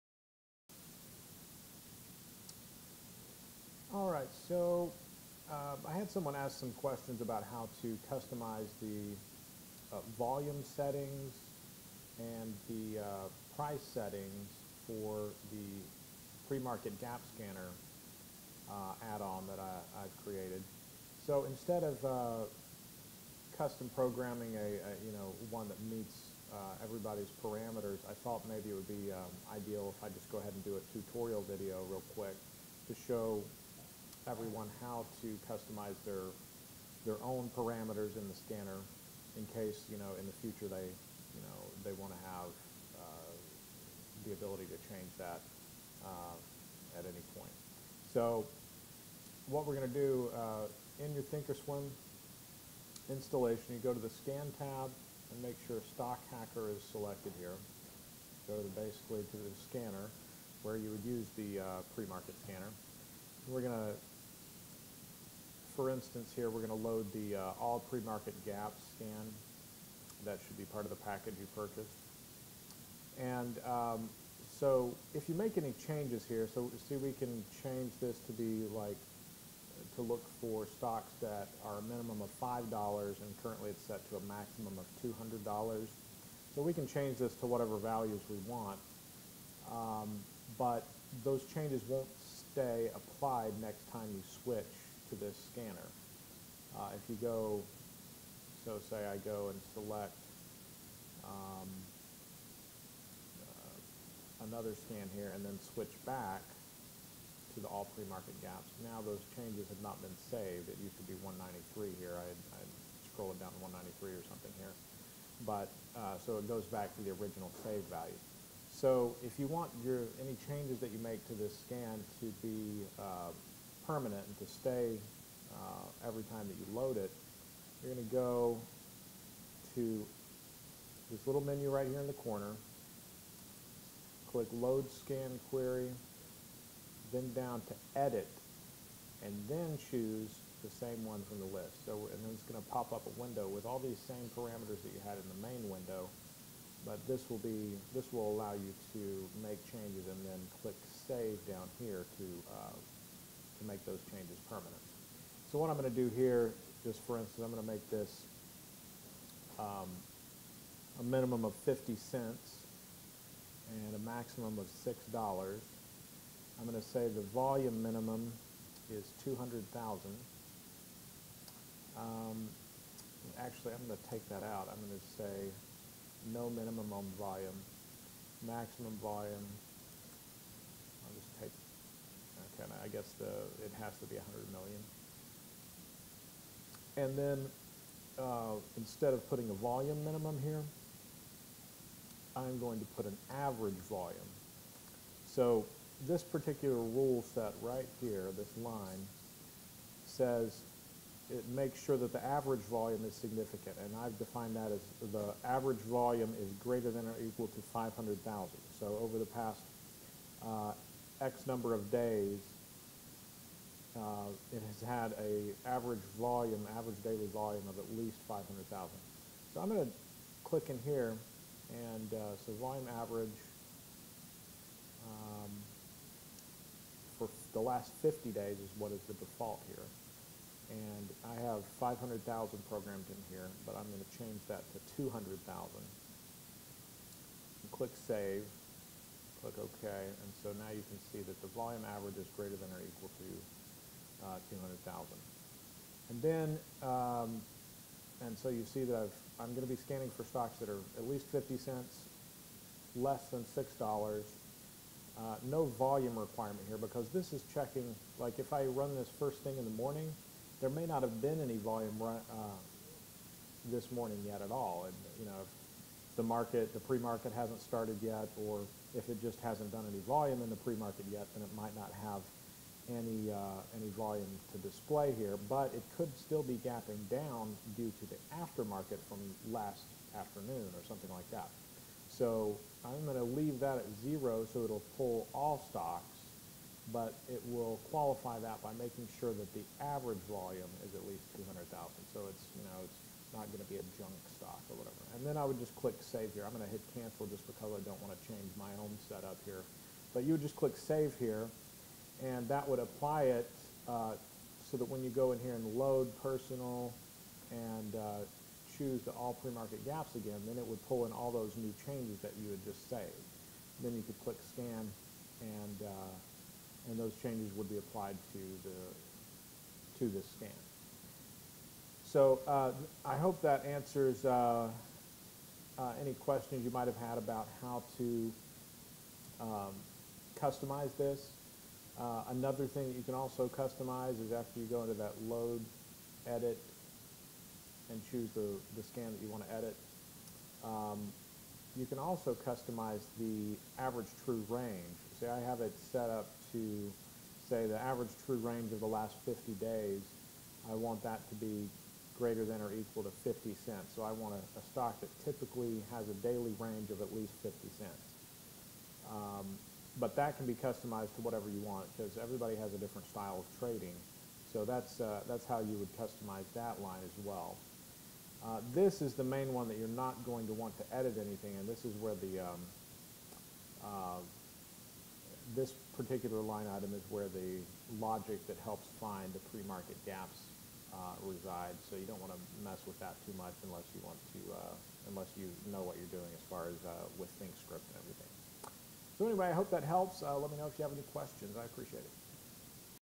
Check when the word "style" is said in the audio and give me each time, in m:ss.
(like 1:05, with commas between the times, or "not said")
6:03.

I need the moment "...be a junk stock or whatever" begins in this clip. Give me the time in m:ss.
4:53.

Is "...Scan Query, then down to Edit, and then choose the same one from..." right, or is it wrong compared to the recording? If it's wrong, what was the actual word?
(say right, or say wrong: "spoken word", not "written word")
right.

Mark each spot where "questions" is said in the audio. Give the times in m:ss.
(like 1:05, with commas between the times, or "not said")
0:06, 5:26, 6:31.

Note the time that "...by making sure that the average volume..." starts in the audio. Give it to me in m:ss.
4:48.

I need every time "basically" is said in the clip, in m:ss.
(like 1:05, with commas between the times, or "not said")
0:58.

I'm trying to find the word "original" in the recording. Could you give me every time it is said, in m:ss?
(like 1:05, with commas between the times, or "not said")
1:57.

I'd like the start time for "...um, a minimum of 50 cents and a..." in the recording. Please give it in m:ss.
2:39.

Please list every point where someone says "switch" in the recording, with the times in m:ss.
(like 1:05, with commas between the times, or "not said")
1:34, 1:45.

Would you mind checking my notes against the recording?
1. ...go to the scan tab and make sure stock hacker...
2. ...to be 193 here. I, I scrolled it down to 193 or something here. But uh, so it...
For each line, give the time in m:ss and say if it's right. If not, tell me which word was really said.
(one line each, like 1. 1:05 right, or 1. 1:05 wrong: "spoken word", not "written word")
1. 0:53 right
2. 1:50 right.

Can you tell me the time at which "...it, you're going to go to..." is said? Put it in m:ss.
2:06.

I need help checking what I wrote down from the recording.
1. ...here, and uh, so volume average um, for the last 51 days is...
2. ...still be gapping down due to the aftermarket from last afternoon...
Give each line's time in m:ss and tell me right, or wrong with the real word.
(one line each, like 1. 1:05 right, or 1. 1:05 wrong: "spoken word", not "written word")
1. 3:40 wrong: "50", not "51"
2. 4:36 right.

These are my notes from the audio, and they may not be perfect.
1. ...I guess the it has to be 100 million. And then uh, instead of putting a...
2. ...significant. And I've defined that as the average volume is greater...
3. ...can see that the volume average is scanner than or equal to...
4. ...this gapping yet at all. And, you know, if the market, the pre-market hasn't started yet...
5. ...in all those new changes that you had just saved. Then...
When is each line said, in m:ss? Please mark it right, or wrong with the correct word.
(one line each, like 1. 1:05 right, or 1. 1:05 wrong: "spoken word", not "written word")
1. 3:02 right
2. 3:23 right
3. 4:00 wrong: "greater", not "scanner"
4. 4:23 wrong: "morning", not "gapping"
5. 5:11 right.